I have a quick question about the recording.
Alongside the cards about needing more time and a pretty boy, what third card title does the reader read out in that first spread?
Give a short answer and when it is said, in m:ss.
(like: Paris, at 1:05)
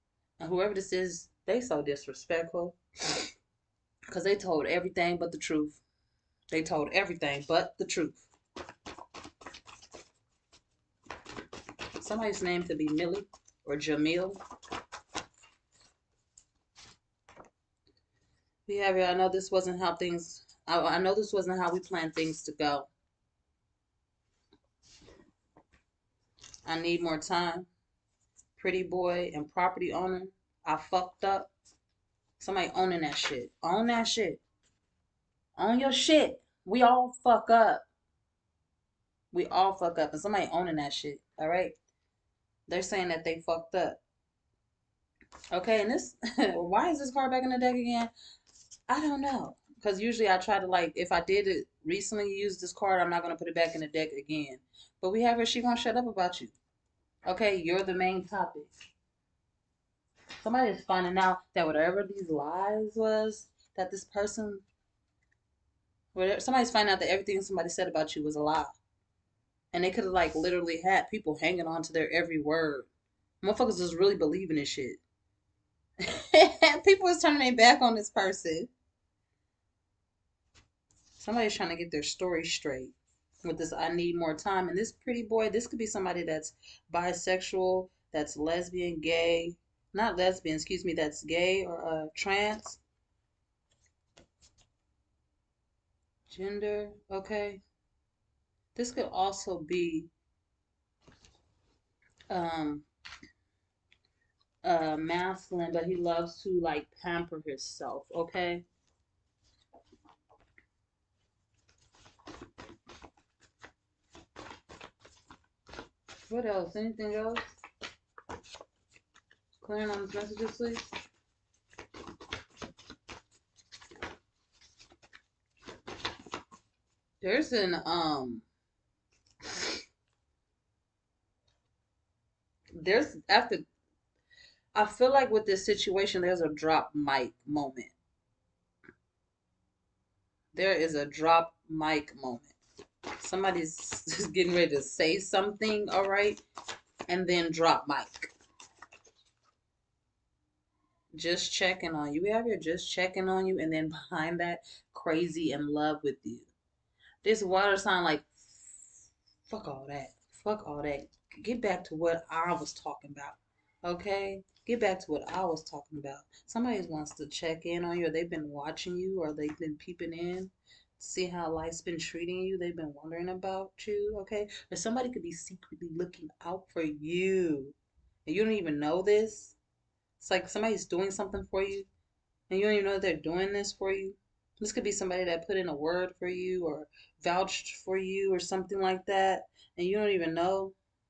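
property owner, at 0:29.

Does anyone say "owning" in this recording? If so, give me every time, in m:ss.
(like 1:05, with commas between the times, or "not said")
0:32, 0:40.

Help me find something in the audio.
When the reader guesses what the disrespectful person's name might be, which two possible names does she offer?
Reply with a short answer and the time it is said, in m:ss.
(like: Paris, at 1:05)
Millie or Jamil, at 0:12.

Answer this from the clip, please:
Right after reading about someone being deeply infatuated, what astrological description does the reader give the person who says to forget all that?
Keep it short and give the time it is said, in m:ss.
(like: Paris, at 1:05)
water sign, at 2:37.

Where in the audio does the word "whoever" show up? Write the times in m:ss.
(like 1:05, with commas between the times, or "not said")
0:00.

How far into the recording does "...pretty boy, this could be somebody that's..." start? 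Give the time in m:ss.
1:24.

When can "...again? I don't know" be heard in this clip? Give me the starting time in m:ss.
0:47.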